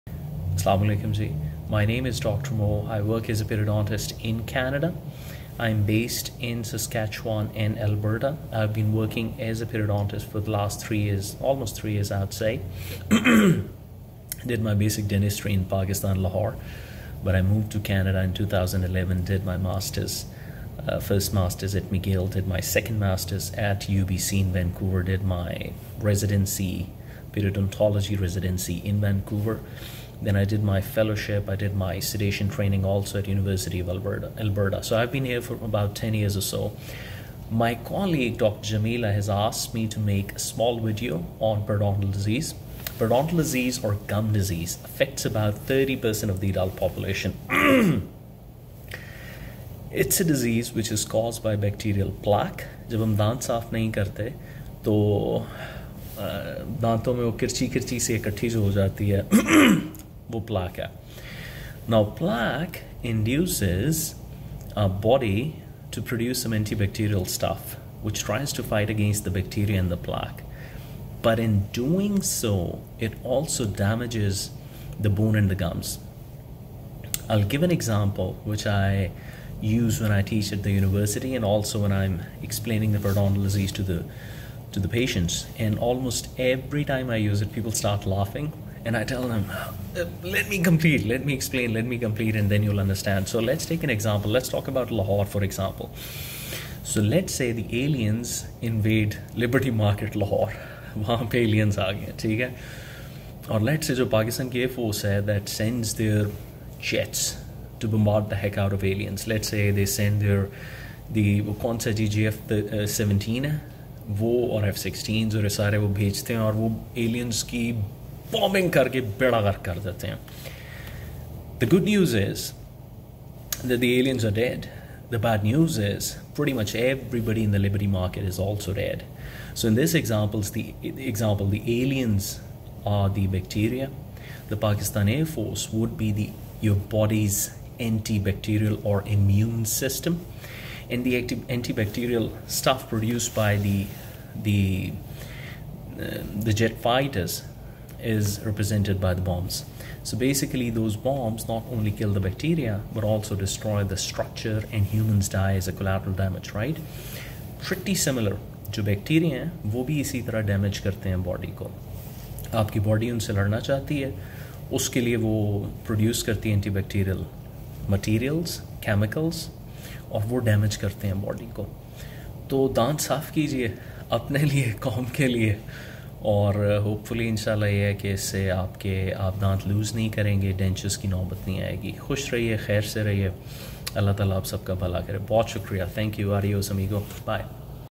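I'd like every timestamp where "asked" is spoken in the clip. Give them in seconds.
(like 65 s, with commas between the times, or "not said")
39 s.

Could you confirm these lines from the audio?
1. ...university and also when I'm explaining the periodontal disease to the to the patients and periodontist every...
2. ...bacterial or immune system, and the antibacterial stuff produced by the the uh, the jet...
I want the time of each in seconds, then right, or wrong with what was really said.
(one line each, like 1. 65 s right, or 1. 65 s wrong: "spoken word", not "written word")
1. 80 s wrong: "almost", not "periodontist"
2. 137 s wrong: "antibacterial", not "bacterial".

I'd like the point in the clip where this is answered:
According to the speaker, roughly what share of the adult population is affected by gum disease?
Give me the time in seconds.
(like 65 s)
45 s.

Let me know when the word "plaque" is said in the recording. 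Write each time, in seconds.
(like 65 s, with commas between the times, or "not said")
52 s, 62 s, 69 s.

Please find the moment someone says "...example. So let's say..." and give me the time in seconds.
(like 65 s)
95 s.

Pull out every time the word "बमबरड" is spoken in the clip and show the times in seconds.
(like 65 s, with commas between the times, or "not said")
107 s.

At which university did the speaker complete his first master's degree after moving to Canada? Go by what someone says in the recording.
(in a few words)
McGill.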